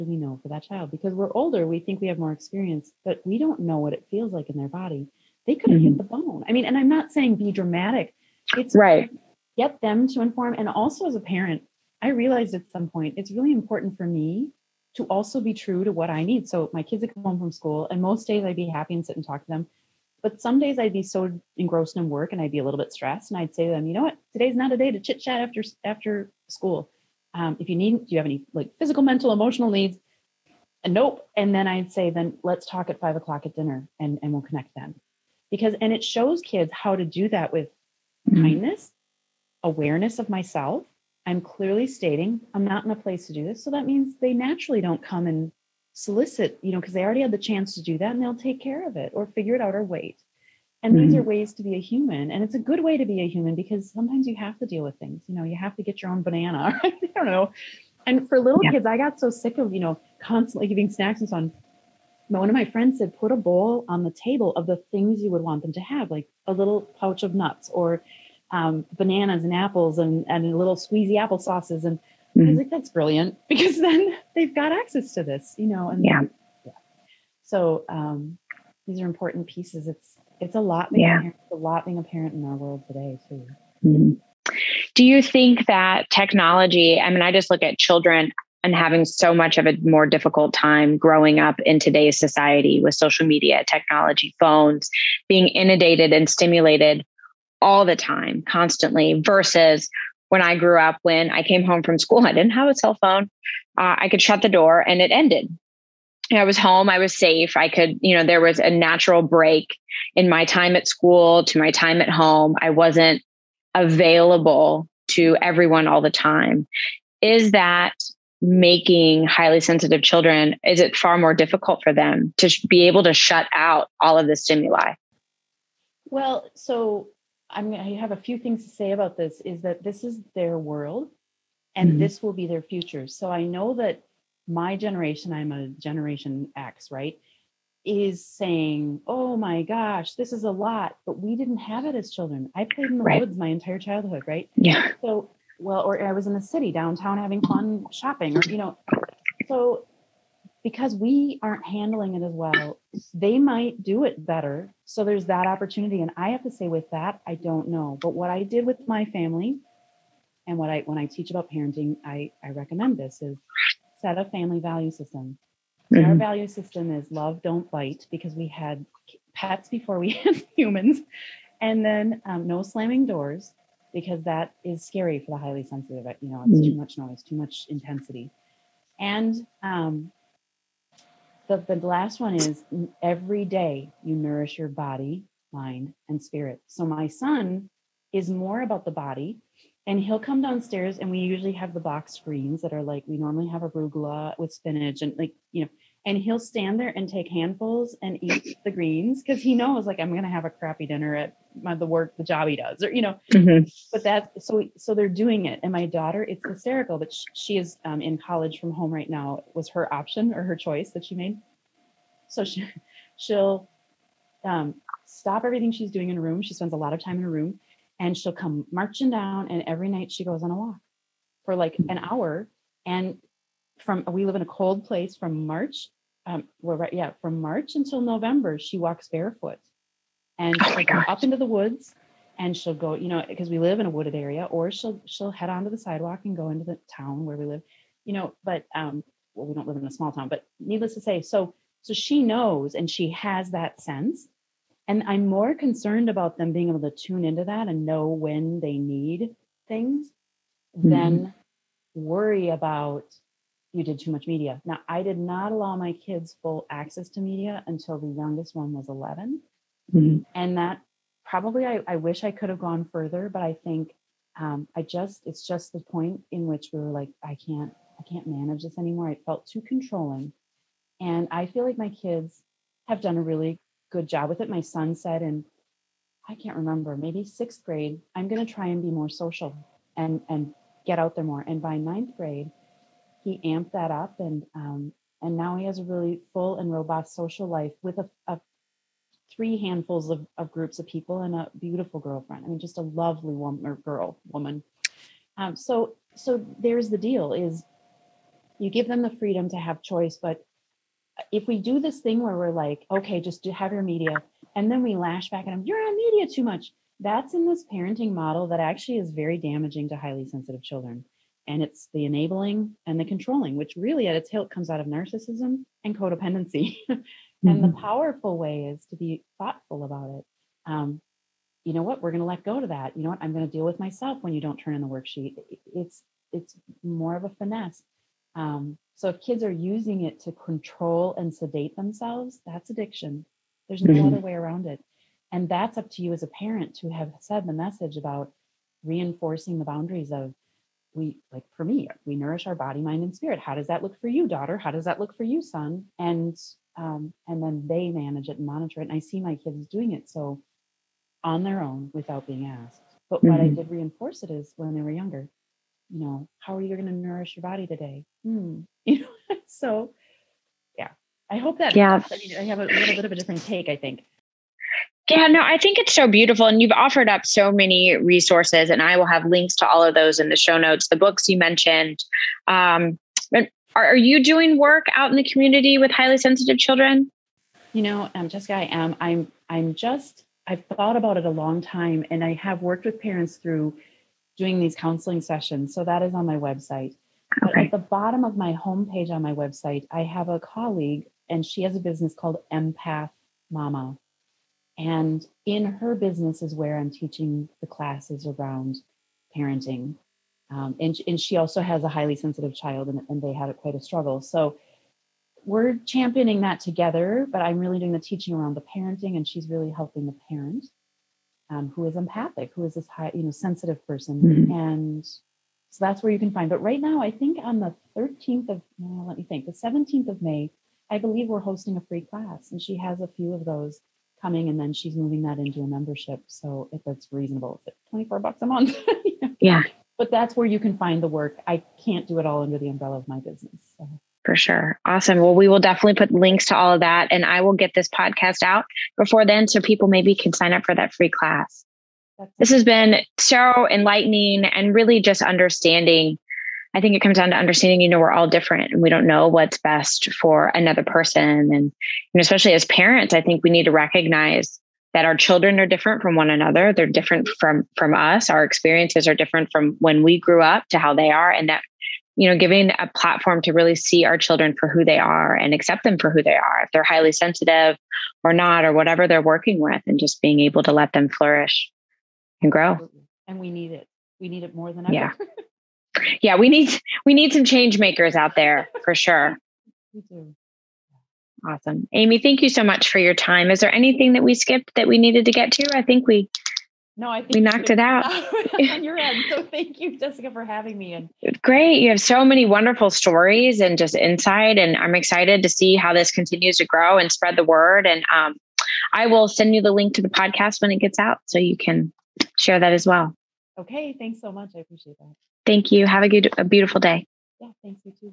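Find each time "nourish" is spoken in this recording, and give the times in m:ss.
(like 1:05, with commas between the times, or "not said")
3:04, 5:42, 5:56.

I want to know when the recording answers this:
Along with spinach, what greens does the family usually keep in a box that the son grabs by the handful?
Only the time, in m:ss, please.
3:13.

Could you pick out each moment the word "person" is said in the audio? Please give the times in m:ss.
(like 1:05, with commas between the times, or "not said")
6:53, 7:30.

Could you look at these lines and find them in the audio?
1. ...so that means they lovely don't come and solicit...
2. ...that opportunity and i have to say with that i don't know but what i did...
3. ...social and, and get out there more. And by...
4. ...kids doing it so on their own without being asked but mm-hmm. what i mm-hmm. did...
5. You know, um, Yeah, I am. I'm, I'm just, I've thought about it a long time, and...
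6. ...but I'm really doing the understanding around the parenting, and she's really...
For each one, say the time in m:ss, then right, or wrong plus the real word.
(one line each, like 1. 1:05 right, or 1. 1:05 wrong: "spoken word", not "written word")
1. 0:43 wrong: "naturally", not "lovely"
2. 2:35 right
3. 4:39 right
4. 5:49 right
5. 6:17 wrong: "Jessica", not "Yeah"
6. 6:47 wrong: "teaching", not "understanding".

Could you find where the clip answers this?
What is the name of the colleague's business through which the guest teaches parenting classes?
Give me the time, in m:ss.
6:32.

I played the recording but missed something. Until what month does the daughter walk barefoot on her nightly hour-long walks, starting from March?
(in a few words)
November.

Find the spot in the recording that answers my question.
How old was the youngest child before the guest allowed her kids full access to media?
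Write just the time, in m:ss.
4:18.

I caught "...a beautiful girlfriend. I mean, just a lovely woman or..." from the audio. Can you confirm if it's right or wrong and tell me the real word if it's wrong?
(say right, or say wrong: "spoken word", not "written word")
right.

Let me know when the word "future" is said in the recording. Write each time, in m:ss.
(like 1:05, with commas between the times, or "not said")
2:12.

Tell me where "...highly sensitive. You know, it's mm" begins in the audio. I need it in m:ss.
2:55.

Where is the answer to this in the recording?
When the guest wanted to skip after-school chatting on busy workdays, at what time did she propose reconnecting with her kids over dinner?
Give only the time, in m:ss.
0:32.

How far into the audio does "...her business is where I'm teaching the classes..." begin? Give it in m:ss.
6:35.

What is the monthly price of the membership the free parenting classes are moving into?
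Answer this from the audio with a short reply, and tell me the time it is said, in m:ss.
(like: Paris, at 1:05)
$24, at 7:07.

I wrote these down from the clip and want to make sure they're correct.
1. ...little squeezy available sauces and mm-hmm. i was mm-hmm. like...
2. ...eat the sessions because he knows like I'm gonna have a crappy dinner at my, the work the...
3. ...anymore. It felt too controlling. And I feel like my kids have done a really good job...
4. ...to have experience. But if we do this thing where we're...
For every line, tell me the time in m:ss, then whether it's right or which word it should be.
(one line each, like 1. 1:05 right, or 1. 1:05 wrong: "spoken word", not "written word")
1. 1:10 wrong: "apple", not "available"
2. 3:18 wrong: "greens", not "sessions"
3. 4:28 right
4. 4:59 wrong: "choice", not "experience".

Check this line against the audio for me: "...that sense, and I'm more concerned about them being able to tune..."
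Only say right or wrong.
right.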